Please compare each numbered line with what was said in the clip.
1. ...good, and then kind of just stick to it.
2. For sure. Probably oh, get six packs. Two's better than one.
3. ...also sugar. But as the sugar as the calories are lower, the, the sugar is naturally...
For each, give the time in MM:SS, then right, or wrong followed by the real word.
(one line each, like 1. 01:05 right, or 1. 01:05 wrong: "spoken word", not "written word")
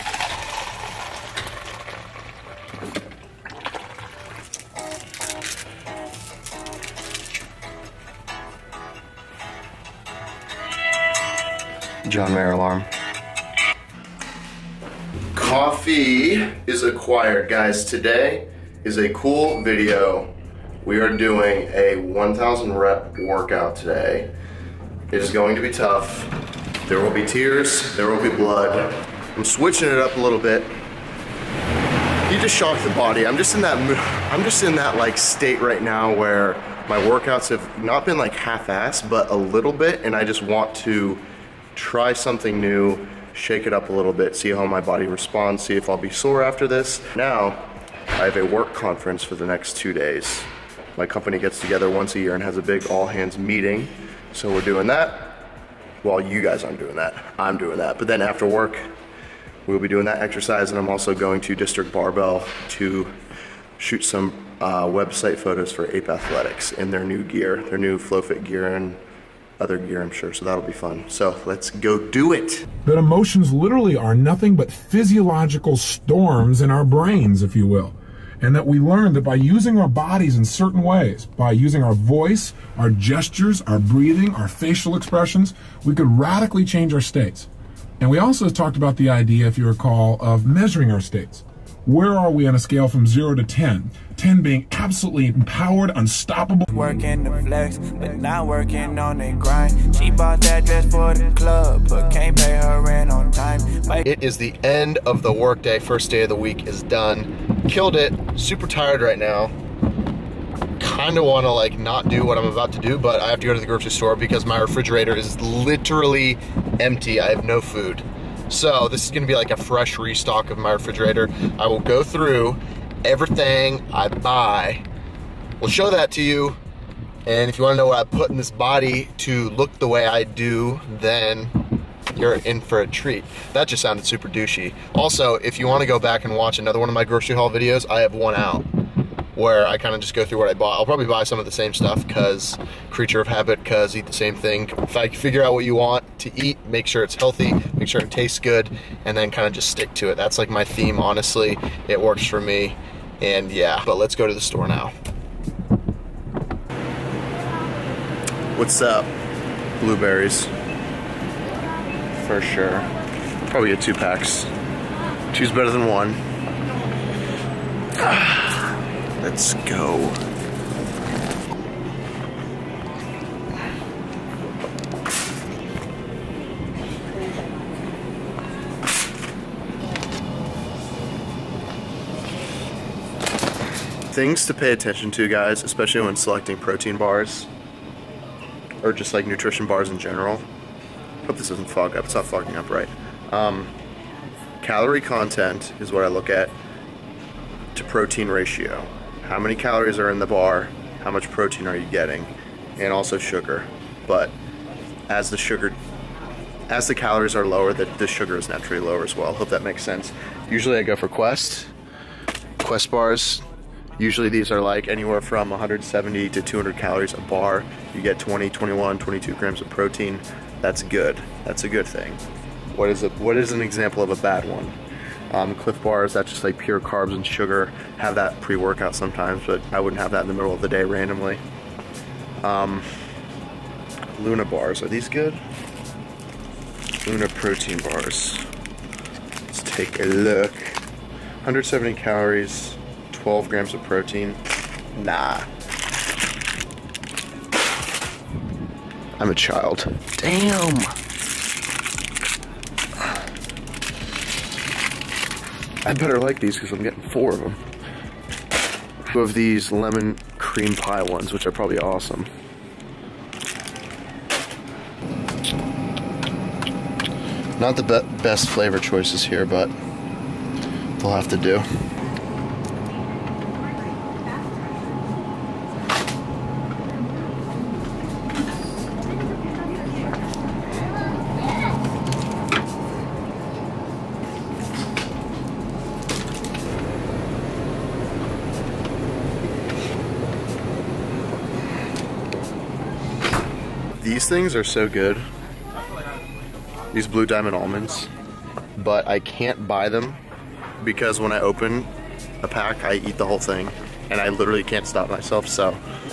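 1. 02:28 right
2. 02:42 wrong: "two", not "six"
3. 03:22 right.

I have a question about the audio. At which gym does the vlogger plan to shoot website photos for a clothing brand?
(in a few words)
District Barbell.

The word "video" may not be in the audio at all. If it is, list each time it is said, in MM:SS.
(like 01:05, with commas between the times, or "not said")
00:19, 02:17.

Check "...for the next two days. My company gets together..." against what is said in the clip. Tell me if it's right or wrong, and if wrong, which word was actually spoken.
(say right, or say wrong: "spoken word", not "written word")
right.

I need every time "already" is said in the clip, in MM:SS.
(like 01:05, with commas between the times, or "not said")
not said.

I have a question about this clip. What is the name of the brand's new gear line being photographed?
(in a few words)
FlowFit.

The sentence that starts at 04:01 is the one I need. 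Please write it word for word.
170 calories, 12 grams of protein.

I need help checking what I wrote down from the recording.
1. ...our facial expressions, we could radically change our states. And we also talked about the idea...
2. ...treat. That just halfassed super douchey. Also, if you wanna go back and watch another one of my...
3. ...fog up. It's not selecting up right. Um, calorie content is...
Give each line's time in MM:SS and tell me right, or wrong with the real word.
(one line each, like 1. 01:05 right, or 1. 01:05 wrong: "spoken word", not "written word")
1. 01:24 right
2. 02:12 wrong: "sounded", not "halfassed"
3. 03:11 wrong: "fogging", not "selecting".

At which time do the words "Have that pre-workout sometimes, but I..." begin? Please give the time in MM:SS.
03:47.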